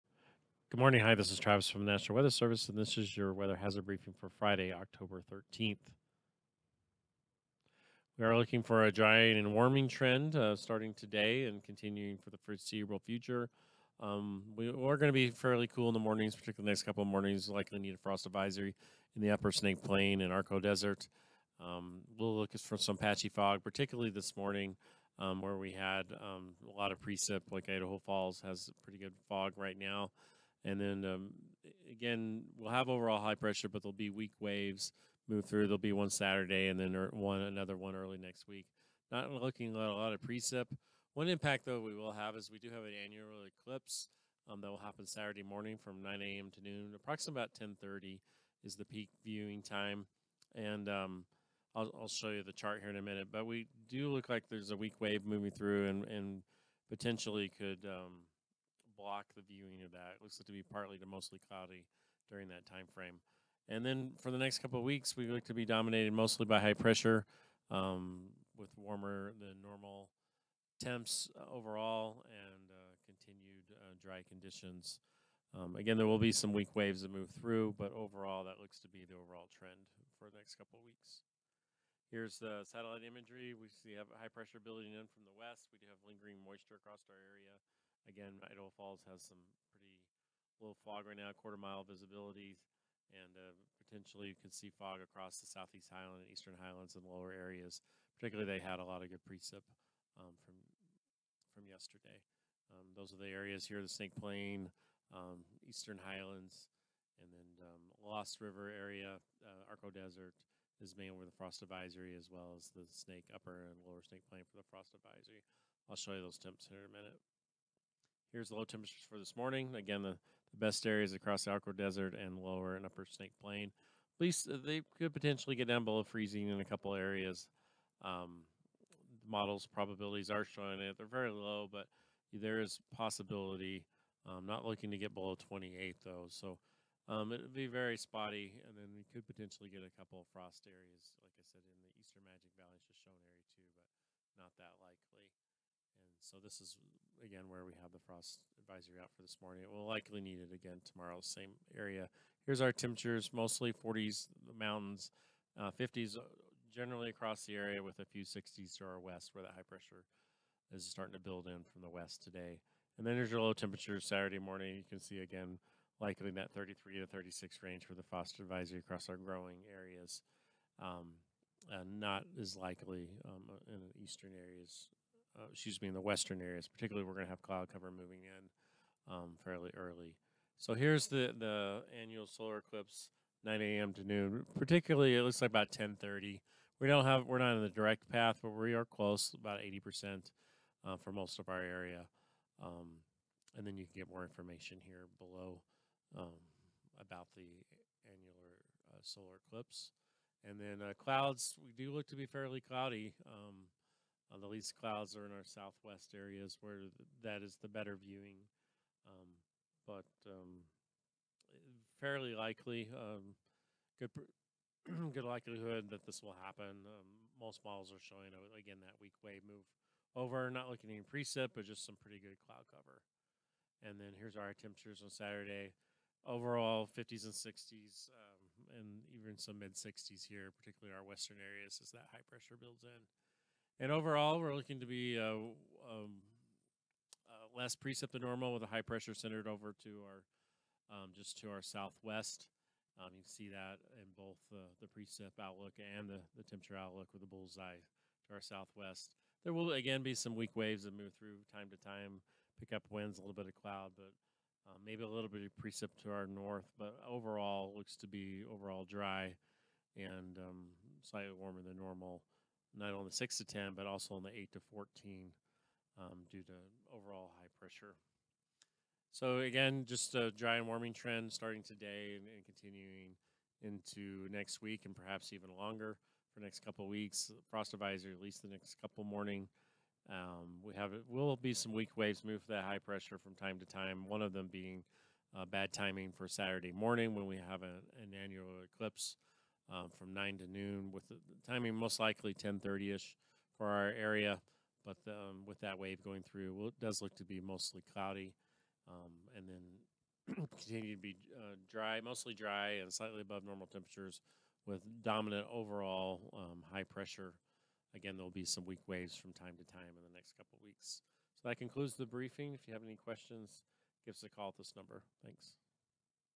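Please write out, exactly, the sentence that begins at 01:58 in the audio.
Here's the low temperatures for this morning.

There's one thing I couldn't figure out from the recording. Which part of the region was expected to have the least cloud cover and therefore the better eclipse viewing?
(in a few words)
southwest areas.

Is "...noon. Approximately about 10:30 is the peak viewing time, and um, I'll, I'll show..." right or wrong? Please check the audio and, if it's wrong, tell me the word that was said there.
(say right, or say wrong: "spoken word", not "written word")
right.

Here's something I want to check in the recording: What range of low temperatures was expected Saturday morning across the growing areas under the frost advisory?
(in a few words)
33 to 36.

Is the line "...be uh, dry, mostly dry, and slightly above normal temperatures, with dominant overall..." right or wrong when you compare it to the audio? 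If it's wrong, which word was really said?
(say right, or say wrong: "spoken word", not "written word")
right.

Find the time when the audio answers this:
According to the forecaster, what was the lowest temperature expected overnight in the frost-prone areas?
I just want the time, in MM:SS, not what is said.
02:15.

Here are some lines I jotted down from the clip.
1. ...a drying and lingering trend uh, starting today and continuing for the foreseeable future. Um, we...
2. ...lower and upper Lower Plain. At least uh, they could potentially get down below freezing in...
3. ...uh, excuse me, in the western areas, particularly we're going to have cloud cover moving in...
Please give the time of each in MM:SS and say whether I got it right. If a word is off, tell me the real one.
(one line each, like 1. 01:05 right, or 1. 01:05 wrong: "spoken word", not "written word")
1. 00:08 wrong: "warming", not "lingering"
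2. 02:02 wrong: "Snake", not "Lower"
3. 02:55 right.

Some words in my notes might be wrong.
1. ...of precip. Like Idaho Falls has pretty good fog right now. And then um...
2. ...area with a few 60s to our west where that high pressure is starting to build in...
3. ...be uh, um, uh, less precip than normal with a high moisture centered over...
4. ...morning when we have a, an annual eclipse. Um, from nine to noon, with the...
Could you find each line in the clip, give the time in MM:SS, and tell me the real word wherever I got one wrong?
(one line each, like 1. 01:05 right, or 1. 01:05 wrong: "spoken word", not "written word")
1. 00:26 right
2. 02:37 right
3. 03:54 wrong: "pressure", not "moisture"
4. 04:46 right.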